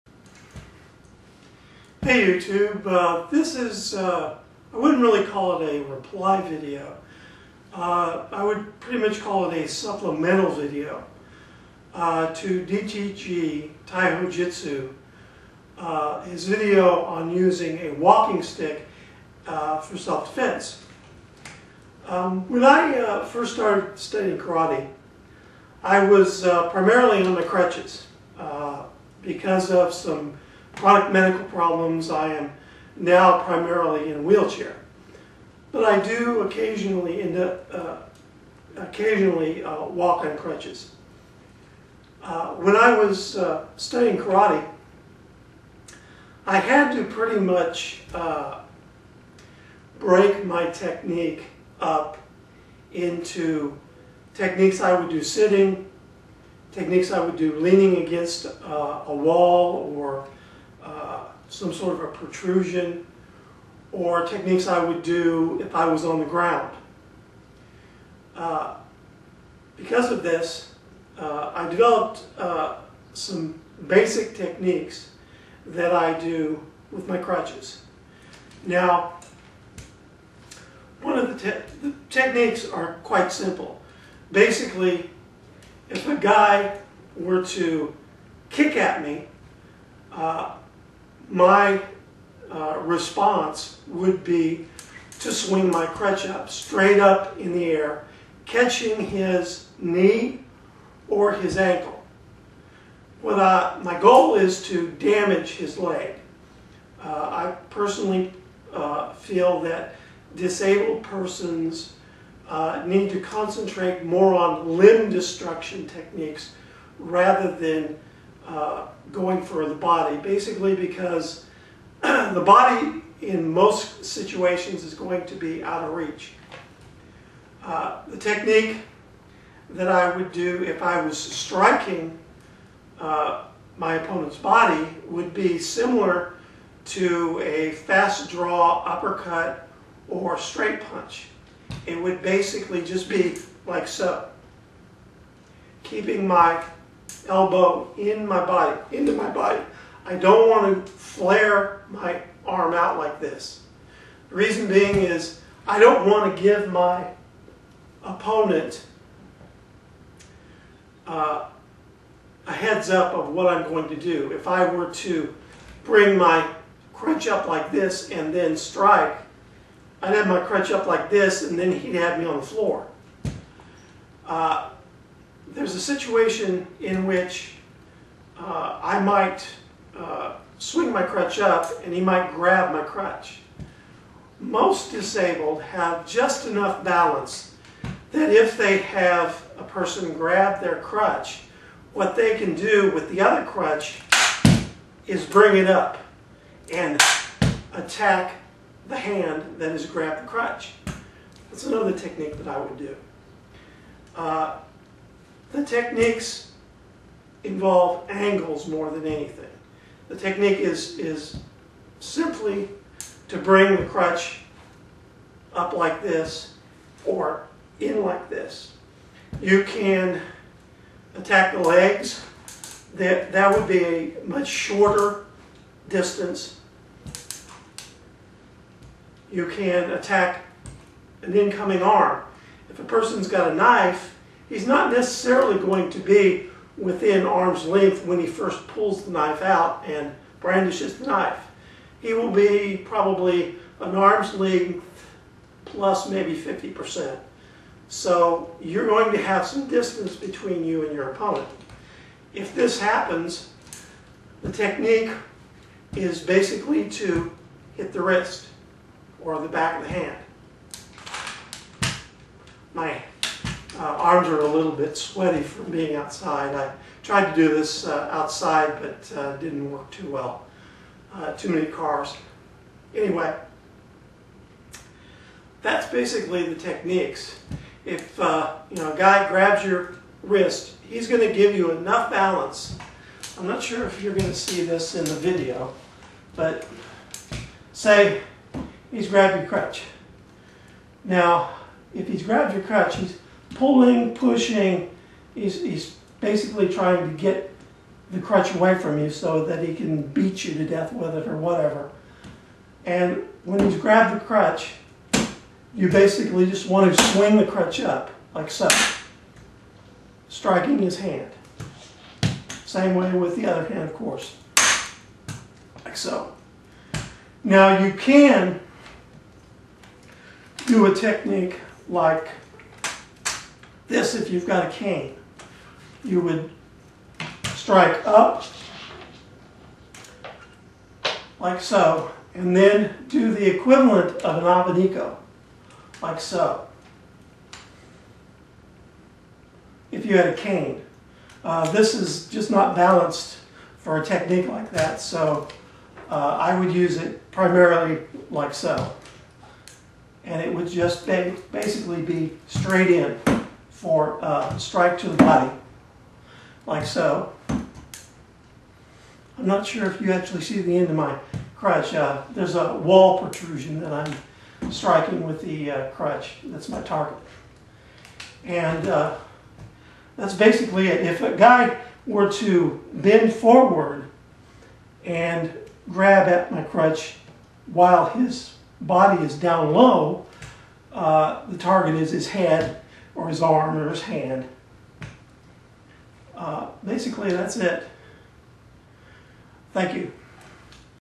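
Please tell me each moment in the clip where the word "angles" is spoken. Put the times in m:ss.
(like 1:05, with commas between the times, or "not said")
3:28.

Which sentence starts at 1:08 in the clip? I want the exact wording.
Uh, because of this, uh, I developed uh, some basic techniques that I do with my crutches.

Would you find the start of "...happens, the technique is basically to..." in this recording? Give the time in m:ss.
4:12.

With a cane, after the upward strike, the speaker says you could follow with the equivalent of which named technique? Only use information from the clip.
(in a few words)
abanico.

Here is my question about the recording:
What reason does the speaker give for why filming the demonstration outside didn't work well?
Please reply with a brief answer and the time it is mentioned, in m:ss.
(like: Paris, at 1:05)
too many cars, at 4:31.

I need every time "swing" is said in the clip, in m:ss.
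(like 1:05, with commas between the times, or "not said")
1:35, 3:00, 5:07.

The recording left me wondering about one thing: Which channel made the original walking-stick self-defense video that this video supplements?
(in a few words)
DTG Taiho Jitsu.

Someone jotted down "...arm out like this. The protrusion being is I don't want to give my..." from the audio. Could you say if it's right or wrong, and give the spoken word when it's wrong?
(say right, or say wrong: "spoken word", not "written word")
wrong: "reason", not "protrusion".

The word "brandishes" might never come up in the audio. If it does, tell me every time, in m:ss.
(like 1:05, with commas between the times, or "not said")
4:00.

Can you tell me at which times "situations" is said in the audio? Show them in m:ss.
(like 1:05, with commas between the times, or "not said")
2:04, 2:55.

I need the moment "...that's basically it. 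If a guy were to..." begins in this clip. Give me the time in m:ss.
6:10.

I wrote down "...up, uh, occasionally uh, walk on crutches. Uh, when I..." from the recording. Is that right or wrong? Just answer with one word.
right.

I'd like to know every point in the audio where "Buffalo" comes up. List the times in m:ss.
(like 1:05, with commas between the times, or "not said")
not said.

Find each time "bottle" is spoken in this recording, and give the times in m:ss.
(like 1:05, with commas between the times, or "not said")
not said.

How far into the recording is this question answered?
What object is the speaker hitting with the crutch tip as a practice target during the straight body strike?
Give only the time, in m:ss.
6:02.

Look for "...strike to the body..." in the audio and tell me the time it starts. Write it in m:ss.
5:54.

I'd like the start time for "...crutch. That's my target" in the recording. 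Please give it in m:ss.
6:05.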